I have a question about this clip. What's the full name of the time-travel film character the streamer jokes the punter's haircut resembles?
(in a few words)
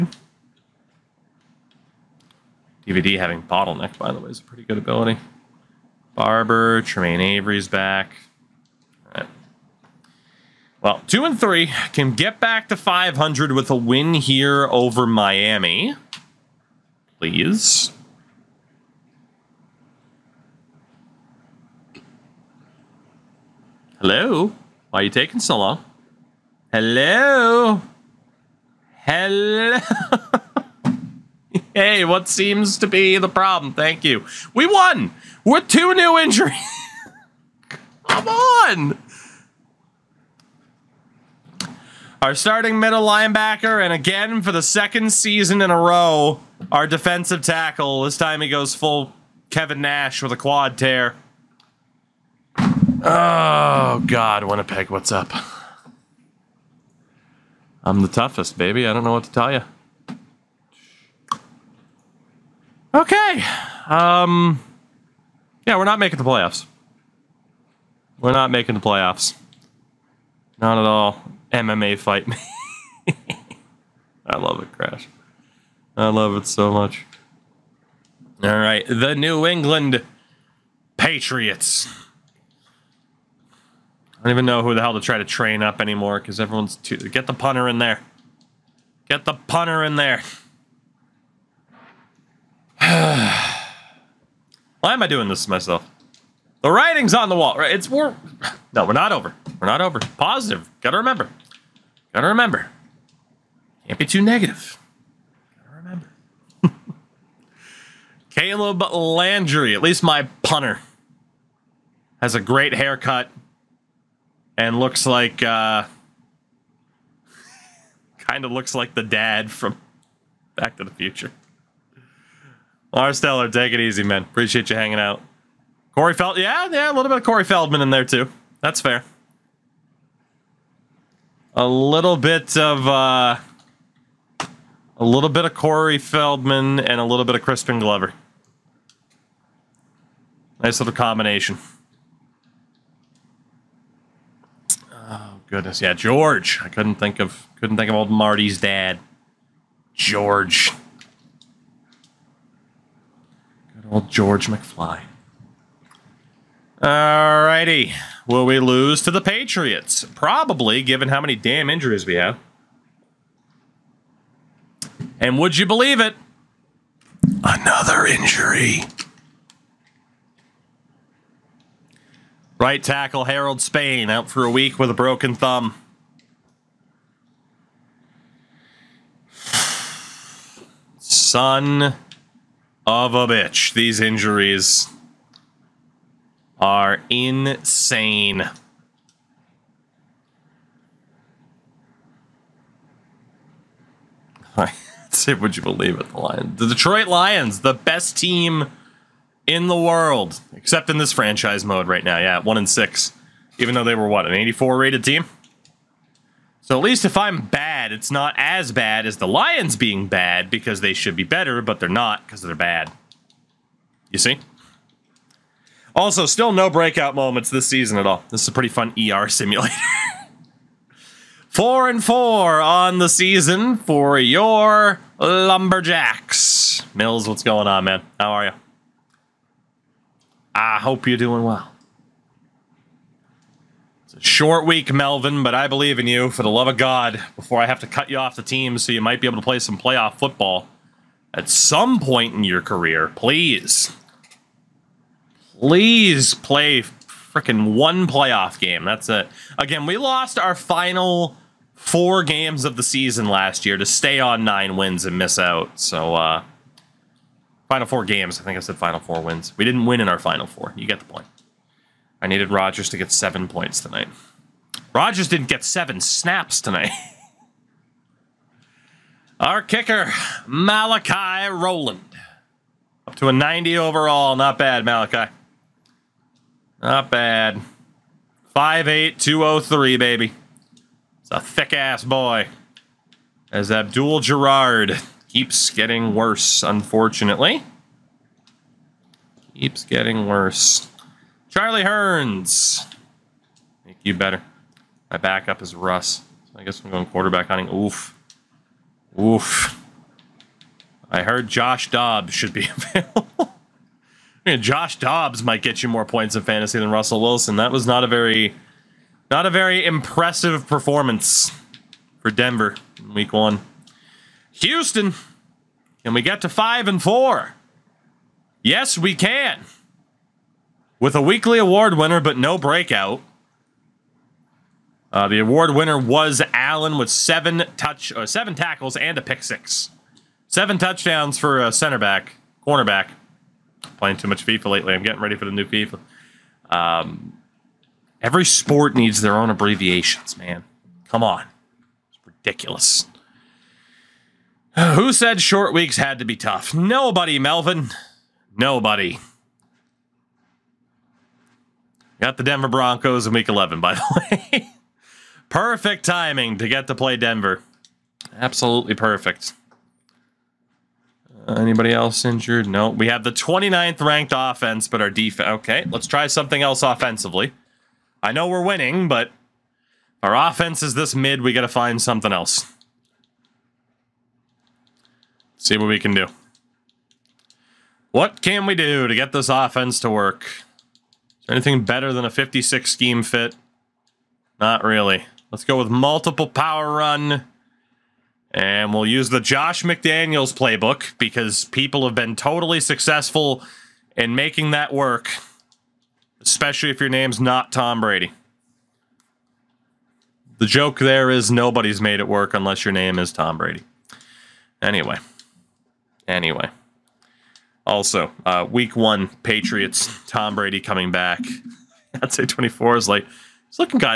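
George McFly.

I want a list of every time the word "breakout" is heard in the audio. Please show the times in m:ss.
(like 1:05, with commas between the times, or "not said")
3:36, 5:22.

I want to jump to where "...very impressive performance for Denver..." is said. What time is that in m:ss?
5:09.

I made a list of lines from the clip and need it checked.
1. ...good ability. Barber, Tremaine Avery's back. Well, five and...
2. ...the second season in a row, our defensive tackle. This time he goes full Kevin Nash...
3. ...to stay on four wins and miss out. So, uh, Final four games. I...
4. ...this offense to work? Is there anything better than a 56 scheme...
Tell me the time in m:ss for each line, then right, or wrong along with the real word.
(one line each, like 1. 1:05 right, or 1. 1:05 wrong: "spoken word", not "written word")
1. 0:04 wrong: "two", not "five"
2. 0:44 right
3. 4:13 wrong: "nine", not "four"
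4. 6:19 right.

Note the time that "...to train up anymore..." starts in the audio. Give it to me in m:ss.
1:25.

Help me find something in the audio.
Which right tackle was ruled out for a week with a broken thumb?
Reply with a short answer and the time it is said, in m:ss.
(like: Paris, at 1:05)
Harold Spain, at 2:53.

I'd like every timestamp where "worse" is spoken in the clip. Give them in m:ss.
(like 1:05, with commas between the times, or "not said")
4:46, 4:50.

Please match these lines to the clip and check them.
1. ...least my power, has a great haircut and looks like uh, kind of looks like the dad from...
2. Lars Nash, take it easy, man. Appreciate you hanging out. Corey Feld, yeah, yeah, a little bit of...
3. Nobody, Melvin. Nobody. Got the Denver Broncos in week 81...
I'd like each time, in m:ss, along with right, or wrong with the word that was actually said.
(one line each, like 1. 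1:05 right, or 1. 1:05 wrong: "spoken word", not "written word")
1. 1:49 wrong: "punter", not "power"
2. 2:02 wrong: "Teller", not "Nash"
3. 5:46 wrong: "11", not "81".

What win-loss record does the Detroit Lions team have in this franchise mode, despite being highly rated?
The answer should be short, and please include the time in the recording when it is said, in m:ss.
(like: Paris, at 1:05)
1-6, at 3:22.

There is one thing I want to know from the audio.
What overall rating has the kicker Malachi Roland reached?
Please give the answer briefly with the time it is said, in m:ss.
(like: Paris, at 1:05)
90, at 4:33.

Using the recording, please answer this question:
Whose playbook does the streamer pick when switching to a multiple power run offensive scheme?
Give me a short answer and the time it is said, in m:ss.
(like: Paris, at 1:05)
Josh McDaniels, at 6:29.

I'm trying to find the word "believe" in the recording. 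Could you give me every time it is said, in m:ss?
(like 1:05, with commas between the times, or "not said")
2:45, 3:15, 3:55.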